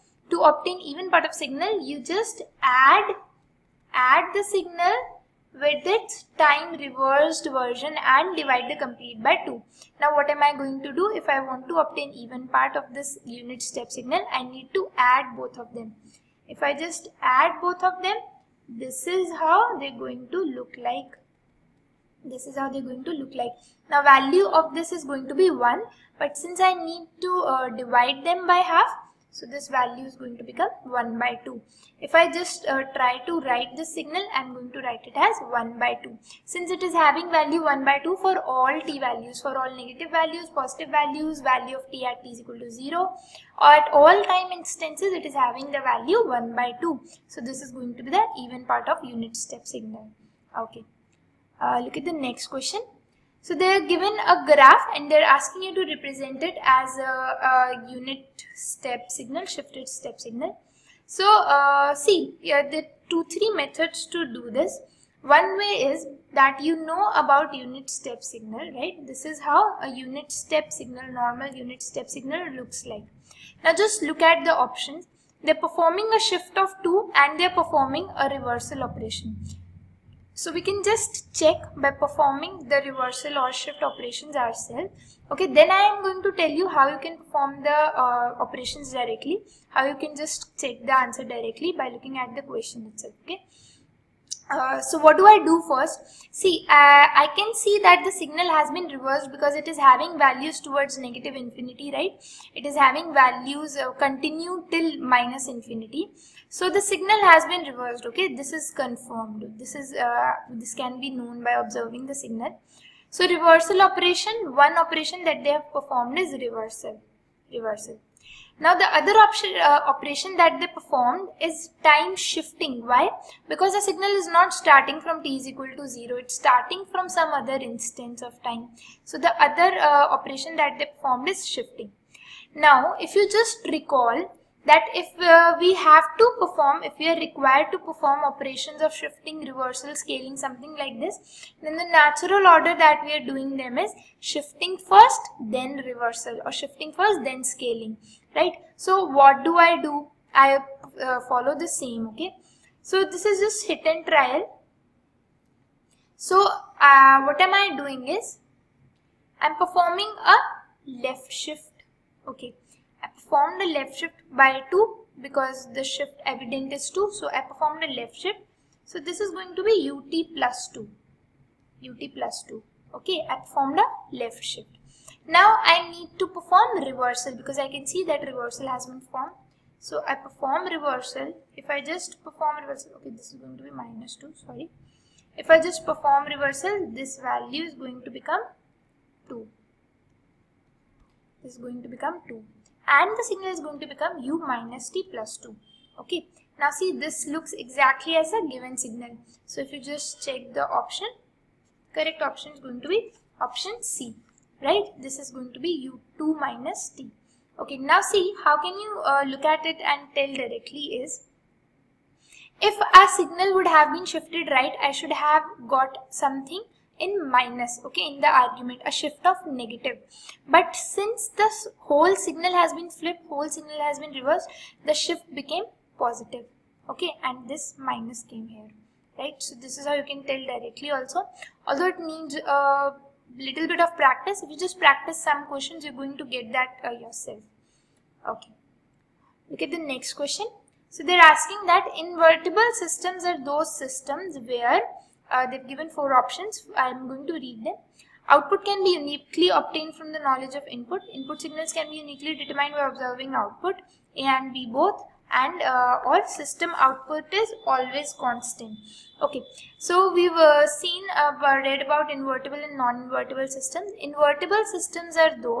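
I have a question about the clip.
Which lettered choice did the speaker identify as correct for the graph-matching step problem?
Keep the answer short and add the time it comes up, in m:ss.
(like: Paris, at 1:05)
Option C, at 3:23.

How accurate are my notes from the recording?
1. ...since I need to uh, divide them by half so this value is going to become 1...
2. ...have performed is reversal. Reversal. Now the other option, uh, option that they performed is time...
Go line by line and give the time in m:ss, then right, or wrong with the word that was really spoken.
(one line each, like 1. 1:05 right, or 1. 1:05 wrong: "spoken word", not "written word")
1. 0:26 right
2. 1:55 wrong: "operation", not "option".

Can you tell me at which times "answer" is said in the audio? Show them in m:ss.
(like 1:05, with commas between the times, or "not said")
1:30.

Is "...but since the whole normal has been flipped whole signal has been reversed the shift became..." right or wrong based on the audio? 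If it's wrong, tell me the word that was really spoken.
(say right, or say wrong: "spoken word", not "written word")
wrong: "signal", not "normal".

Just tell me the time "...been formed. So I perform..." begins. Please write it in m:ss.
2:58.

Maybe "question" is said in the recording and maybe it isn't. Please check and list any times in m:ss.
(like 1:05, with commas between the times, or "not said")
0:52, 1:32, 3:55, 4:00.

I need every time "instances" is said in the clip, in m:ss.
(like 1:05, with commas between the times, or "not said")
0:44, 2:07.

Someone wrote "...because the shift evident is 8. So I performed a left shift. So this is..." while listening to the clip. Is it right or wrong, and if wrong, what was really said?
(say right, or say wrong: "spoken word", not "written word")
wrong: "2", not "8".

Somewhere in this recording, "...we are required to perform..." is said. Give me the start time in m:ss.
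2:16.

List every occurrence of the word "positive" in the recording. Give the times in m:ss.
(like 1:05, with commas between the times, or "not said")
0:40, 3:46.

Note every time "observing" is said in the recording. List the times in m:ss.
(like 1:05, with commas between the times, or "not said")
1:51, 4:12.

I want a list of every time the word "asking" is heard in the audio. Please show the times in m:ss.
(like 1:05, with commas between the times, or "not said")
0:55, 4:01.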